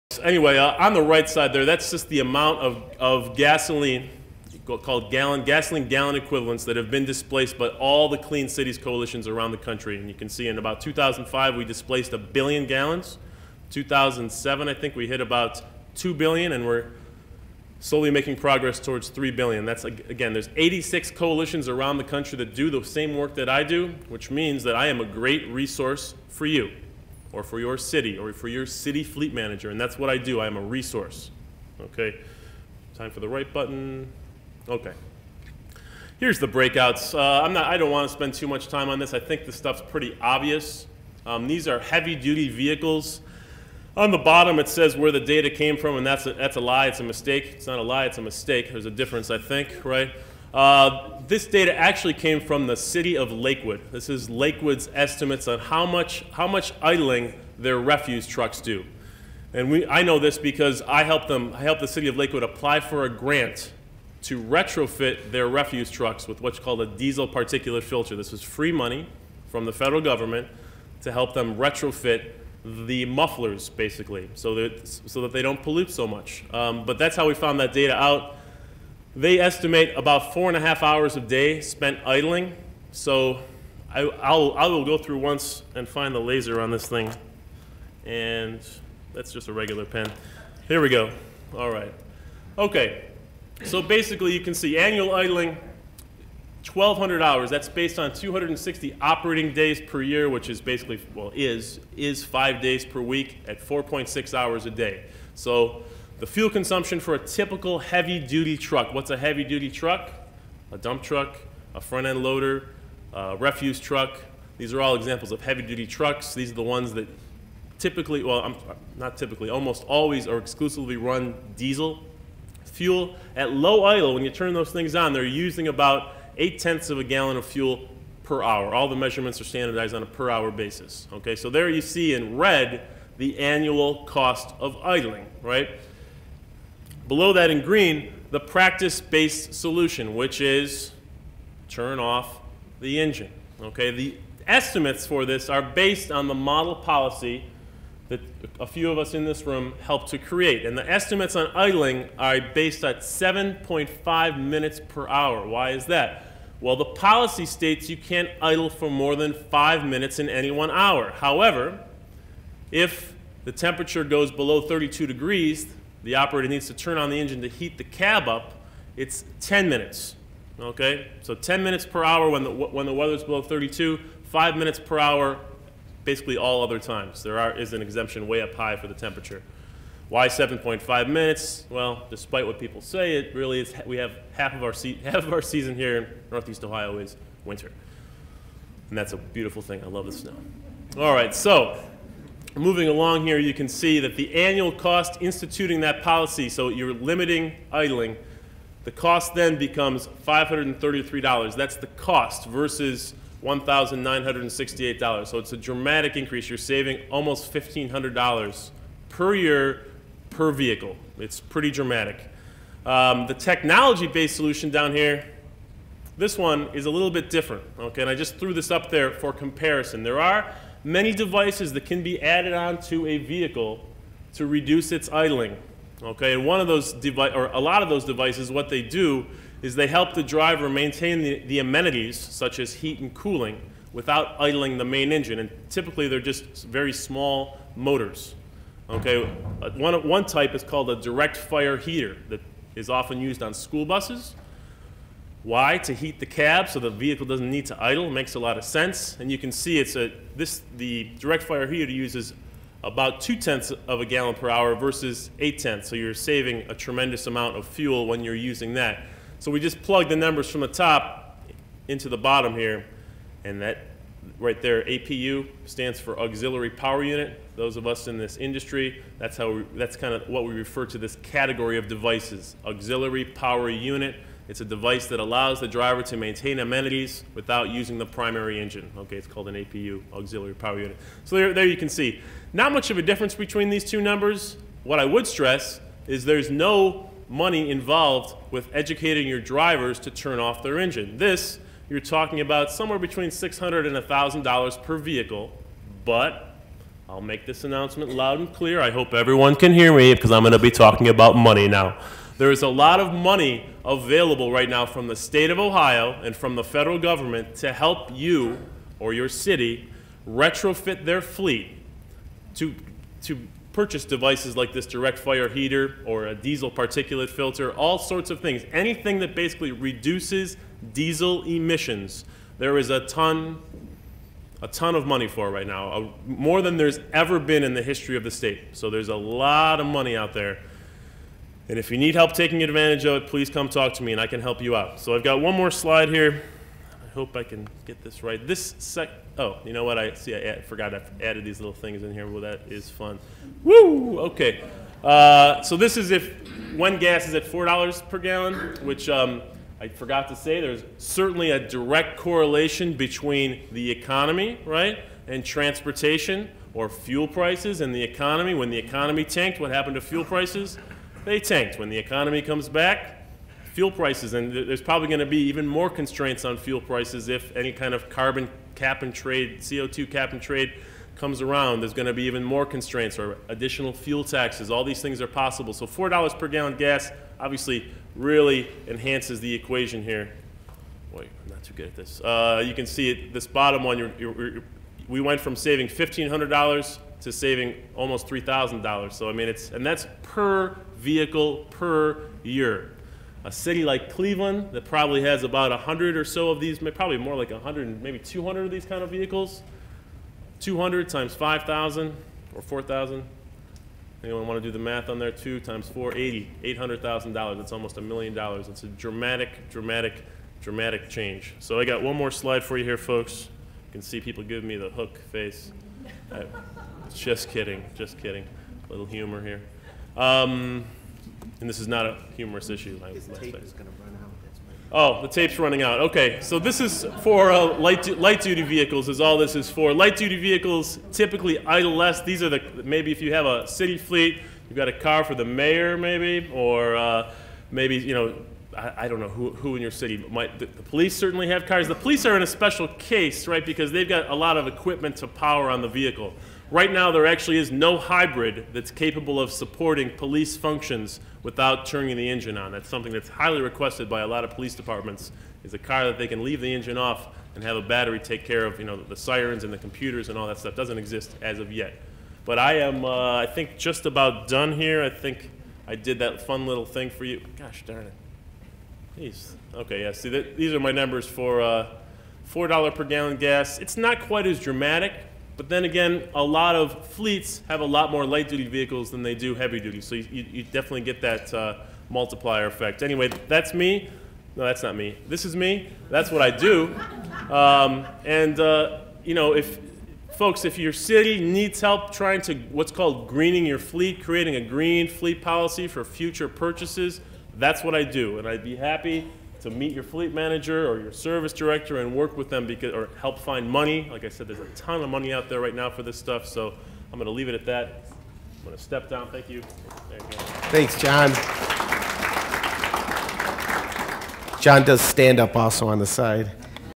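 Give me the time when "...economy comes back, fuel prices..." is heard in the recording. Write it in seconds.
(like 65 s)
361 s.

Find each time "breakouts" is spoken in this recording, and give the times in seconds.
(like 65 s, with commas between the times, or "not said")
36 s.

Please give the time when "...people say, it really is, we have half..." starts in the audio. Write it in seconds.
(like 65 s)
182 s.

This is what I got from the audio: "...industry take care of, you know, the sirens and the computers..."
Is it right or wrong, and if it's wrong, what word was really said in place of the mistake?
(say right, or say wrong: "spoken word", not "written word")
wrong: "battery", not "industry".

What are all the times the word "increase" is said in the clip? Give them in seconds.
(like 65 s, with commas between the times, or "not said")
206 s.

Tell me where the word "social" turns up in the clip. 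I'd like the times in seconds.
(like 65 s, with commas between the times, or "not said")
not said.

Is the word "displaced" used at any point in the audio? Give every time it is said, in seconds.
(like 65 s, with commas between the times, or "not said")
7 s, 11 s.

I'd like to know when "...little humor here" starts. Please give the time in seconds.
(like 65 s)
418 s.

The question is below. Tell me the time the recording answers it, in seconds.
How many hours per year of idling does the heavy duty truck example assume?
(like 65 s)
96 s.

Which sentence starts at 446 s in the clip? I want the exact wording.
Right now, there actually is no hybrid that's capable of supporting police functions without turning the engine on.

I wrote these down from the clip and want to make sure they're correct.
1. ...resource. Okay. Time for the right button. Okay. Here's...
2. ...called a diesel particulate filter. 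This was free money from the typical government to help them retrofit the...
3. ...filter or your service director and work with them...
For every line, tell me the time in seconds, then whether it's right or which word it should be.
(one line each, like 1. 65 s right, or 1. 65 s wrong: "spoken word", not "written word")
1. 30 s right
2. 66 s wrong: "federal", not "typical"
3. 500 s wrong: "manager", not "filter".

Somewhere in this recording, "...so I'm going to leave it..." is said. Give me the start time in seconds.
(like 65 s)
506 s.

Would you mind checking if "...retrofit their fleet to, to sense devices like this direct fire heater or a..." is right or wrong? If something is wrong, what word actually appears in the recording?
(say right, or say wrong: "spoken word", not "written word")
wrong: "purchase", not "sense".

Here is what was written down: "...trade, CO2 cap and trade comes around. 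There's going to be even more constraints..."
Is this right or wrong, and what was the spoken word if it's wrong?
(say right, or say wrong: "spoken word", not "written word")
right.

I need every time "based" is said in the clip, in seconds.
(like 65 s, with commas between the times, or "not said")
97 s, 138 s, 145 s, 152 s, 213 s.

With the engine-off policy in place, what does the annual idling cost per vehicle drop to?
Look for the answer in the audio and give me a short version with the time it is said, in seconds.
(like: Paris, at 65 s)
$533, at 200 s.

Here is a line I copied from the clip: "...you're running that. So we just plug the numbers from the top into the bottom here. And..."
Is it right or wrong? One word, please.
wrong.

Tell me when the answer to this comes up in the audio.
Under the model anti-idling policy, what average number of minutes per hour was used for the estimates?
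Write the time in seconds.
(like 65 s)
152 s.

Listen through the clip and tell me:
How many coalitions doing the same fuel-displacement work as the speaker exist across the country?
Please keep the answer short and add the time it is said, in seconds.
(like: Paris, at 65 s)
86, at 20 s.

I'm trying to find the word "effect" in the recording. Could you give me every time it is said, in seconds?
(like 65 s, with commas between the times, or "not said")
482 s.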